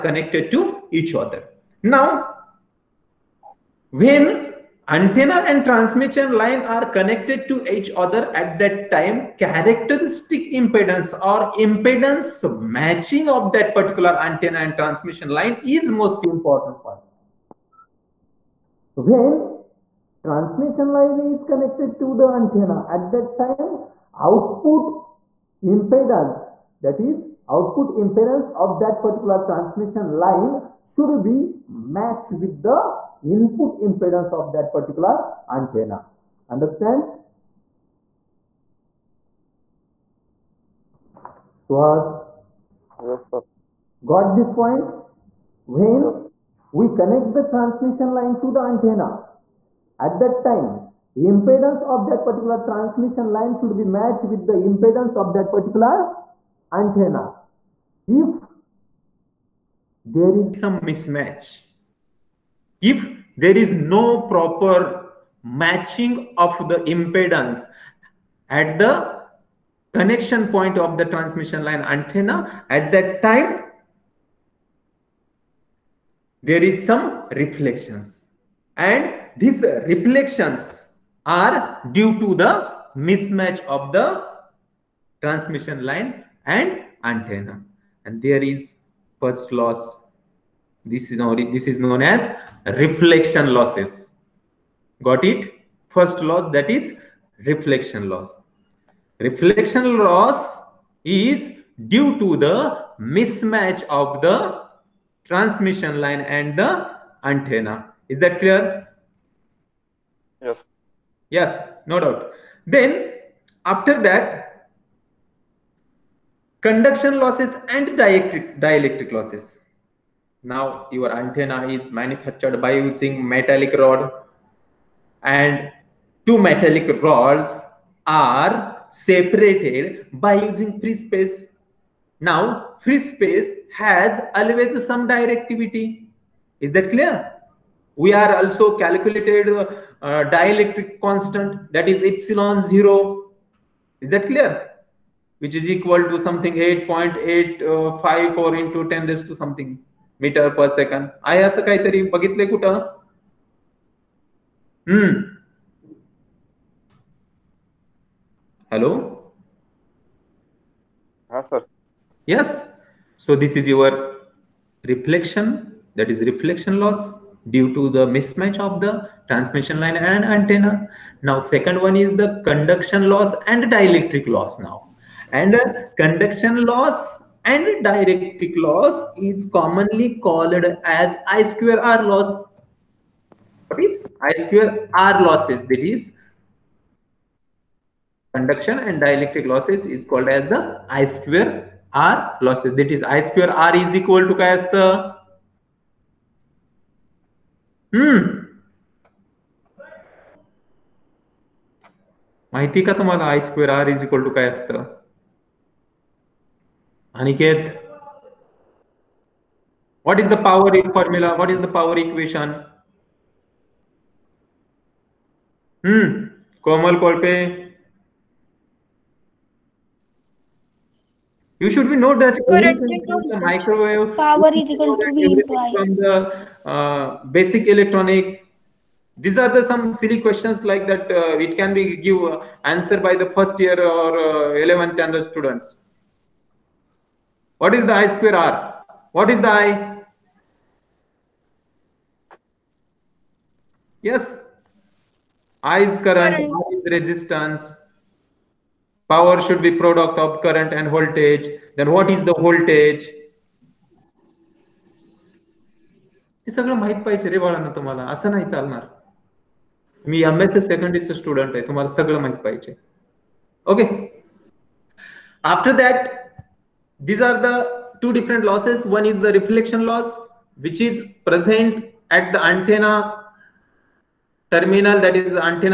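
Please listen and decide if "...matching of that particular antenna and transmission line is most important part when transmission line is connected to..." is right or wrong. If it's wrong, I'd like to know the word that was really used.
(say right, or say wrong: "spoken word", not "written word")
right.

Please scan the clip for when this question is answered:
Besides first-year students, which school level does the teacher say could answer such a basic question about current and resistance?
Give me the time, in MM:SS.
03:54.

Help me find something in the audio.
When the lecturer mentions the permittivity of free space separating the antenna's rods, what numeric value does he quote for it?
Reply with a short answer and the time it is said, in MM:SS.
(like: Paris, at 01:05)
8.854, at 02:26.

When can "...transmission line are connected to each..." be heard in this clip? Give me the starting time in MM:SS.
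00:05.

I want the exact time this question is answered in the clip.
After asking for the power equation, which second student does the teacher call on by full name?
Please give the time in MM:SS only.
03:36.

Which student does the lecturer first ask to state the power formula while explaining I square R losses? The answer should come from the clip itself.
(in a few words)
Aniket.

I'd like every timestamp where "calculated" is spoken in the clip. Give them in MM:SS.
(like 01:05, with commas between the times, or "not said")
02:18.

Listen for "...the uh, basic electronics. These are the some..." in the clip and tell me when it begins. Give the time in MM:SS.
03:45.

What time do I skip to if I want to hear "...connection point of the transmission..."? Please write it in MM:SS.
01:09.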